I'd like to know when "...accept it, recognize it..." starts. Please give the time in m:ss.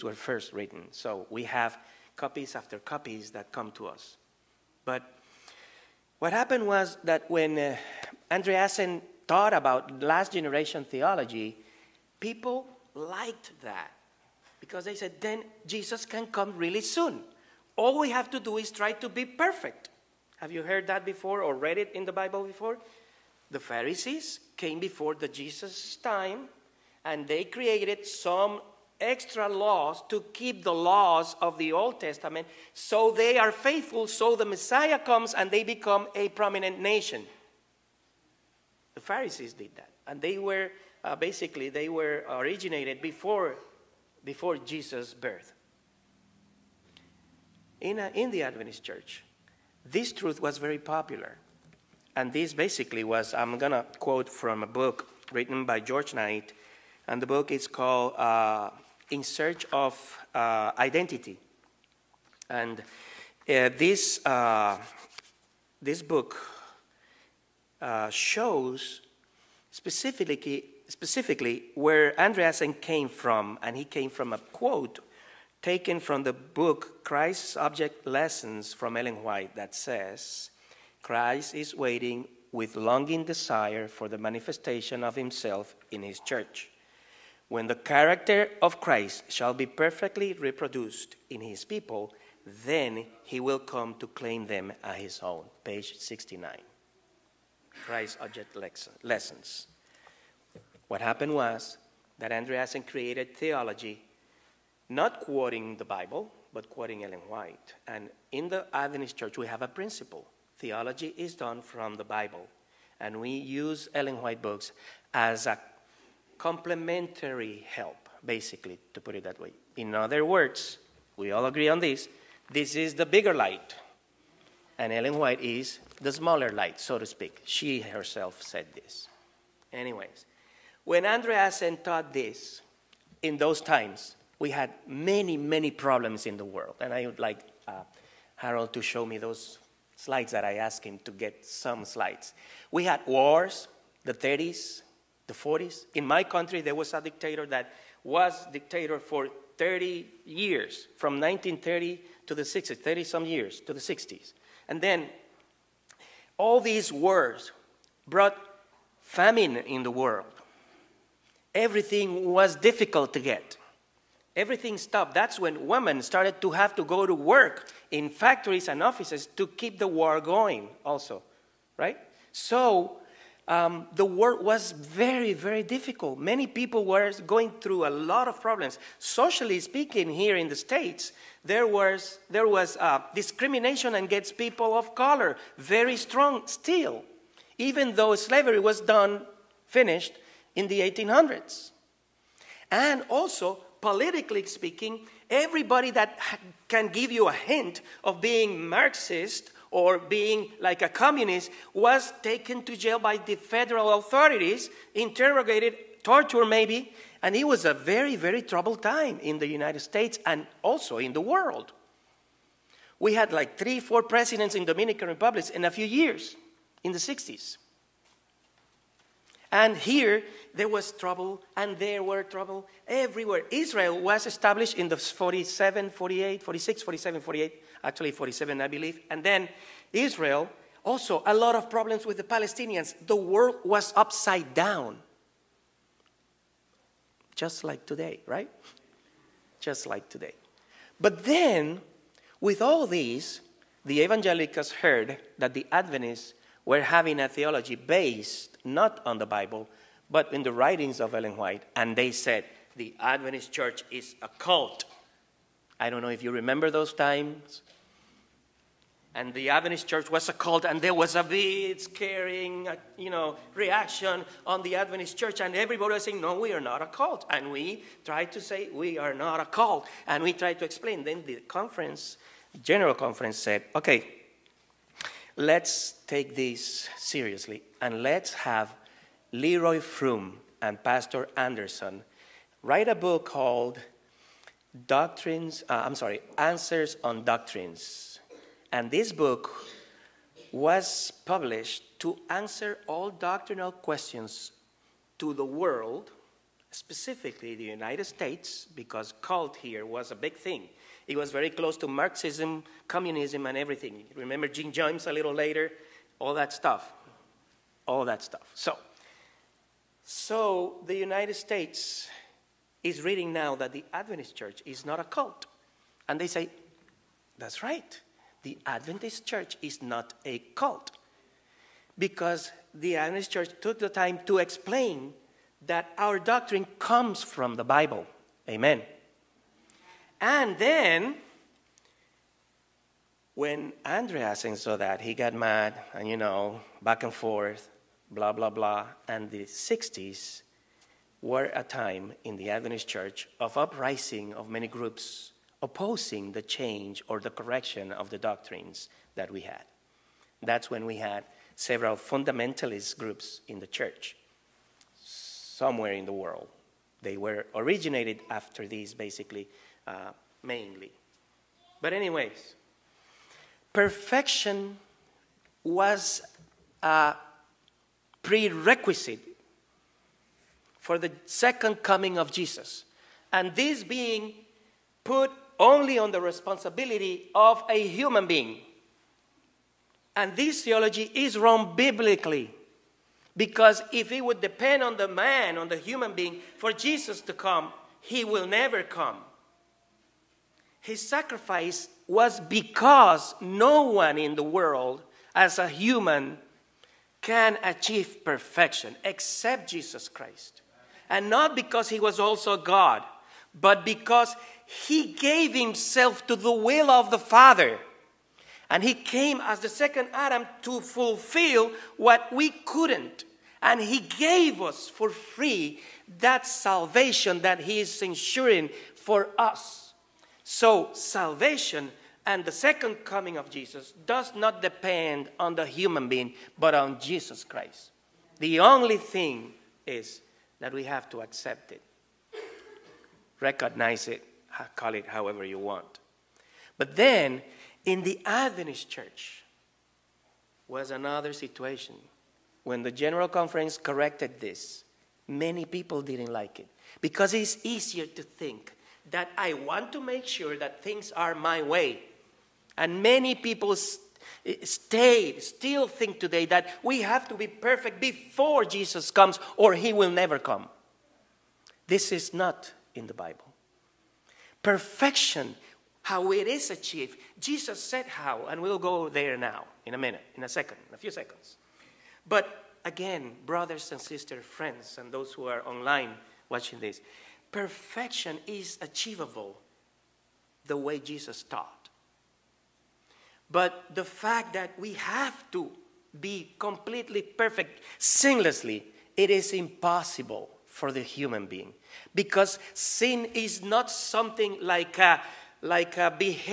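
7:11.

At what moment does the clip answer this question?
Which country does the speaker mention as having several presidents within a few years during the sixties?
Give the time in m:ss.
3:34.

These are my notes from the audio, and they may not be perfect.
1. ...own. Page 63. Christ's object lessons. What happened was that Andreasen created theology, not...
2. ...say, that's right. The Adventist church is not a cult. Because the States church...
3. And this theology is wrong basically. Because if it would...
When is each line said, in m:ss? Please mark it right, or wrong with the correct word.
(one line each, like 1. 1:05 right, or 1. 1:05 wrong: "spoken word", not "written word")
1. 1:35 wrong: "69", not "63"
2. 5:16 wrong: "Adventist", not "States"
3. 6:20 wrong: "biblically", not "basically".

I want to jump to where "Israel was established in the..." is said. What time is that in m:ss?
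3:43.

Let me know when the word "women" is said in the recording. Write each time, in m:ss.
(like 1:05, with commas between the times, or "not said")
2:45.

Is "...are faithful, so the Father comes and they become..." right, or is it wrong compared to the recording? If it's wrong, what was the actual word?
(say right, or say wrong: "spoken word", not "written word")
wrong: "Messiah", not "Father".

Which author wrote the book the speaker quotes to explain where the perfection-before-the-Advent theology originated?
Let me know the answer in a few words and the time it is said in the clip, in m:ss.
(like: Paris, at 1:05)
George Knight, at 0:55.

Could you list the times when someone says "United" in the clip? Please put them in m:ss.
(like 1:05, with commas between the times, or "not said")
3:29, 4:57, 5:10.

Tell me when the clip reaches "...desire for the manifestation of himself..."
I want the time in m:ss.
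1:23.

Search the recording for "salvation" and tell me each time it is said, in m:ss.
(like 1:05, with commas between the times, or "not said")
6:56, 7:00.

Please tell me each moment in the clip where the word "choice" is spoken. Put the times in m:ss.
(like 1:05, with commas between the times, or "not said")
not said.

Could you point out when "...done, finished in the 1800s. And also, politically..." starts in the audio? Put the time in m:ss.
3:08.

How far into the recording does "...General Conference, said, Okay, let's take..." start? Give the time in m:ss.
4:32.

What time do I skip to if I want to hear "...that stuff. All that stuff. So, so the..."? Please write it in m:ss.
5:06.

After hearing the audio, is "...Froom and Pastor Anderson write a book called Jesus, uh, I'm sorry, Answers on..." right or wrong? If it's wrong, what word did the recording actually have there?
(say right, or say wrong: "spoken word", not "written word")
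wrong: "Doctrines", not "Jesus".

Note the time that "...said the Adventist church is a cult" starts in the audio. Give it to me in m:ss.
4:12.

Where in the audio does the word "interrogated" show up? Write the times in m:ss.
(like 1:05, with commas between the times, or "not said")
3:24.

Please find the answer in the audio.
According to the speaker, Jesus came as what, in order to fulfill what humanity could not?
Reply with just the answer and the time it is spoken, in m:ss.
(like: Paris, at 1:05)
the second Adam, at 6:49.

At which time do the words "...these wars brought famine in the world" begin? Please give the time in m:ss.
2:36.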